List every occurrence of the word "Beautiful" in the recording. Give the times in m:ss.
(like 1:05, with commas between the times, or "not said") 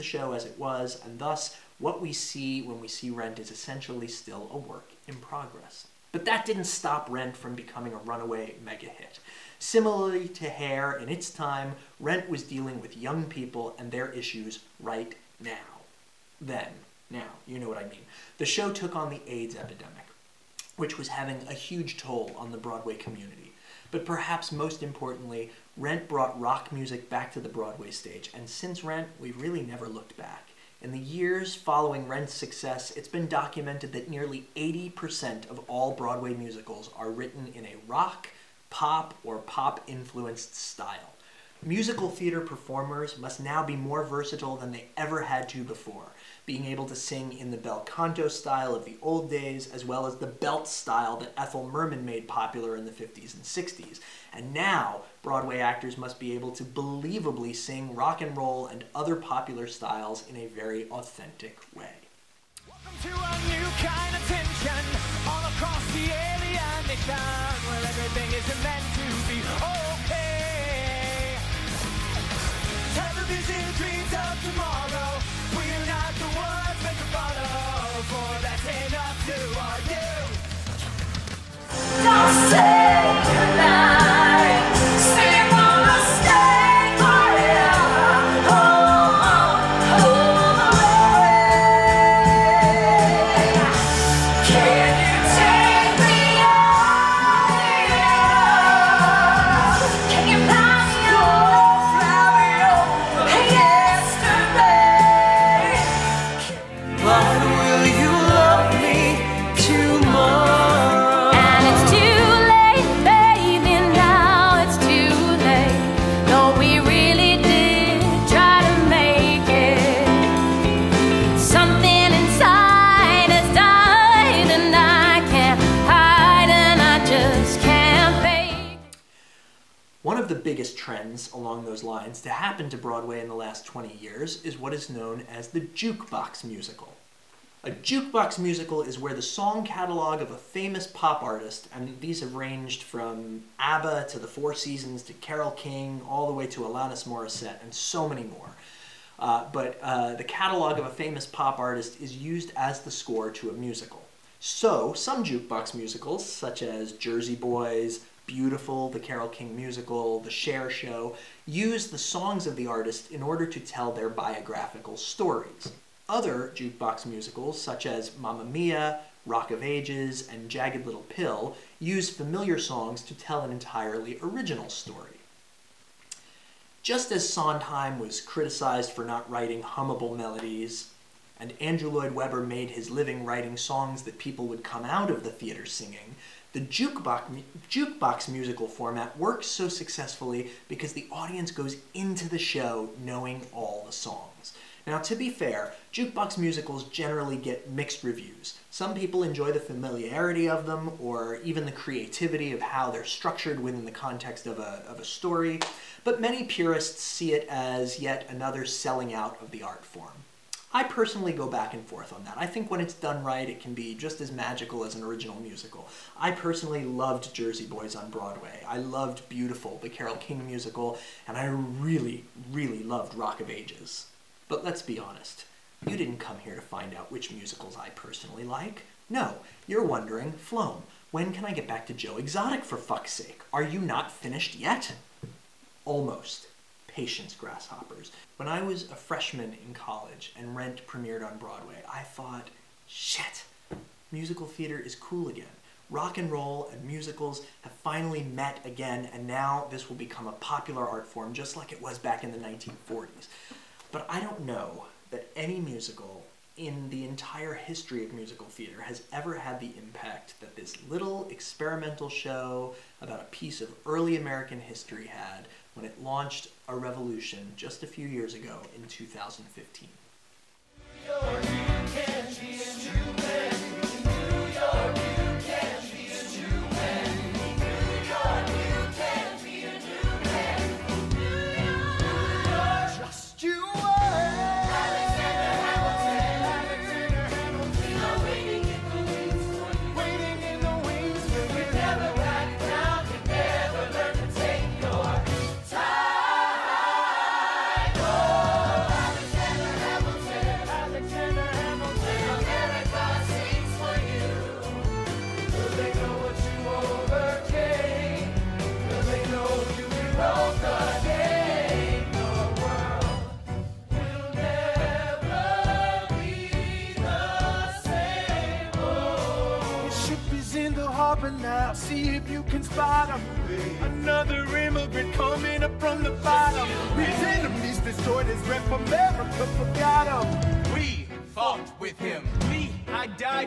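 2:38, 3:39.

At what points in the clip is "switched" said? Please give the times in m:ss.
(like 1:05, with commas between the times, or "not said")
not said.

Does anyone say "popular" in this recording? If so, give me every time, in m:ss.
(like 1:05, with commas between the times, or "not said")
0:52, 0:59, 4:10.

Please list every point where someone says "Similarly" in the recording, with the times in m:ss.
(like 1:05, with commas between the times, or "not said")
0:09.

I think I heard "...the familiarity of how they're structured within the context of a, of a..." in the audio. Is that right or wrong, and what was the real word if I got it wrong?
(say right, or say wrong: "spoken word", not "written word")
wrong: "creativity", not "familiarity".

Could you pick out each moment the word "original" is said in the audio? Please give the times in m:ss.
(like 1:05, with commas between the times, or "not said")
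2:54, 3:35.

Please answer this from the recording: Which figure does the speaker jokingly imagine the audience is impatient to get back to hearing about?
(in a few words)
Joe Exotic.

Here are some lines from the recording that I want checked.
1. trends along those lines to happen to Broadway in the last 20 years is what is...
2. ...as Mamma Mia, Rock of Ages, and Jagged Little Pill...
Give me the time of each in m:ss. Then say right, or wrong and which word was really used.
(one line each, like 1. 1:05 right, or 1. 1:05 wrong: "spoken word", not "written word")
1. 2:10 right
2. 2:47 right.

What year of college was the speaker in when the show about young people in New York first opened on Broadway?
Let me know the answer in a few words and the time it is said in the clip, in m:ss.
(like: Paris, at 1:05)
Freshman, at 3:58.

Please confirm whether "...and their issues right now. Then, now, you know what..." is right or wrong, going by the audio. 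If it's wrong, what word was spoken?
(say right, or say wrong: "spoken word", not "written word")
right.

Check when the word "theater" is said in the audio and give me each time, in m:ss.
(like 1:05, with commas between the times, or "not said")
0:42, 3:05, 4:04, 4:18.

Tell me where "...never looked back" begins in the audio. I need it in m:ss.
0:29.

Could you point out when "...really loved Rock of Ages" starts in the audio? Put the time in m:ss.
3:42.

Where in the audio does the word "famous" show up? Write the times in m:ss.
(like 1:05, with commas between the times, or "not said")
2:20, 2:30.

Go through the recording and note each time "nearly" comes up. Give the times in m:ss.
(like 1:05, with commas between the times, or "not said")
0:34.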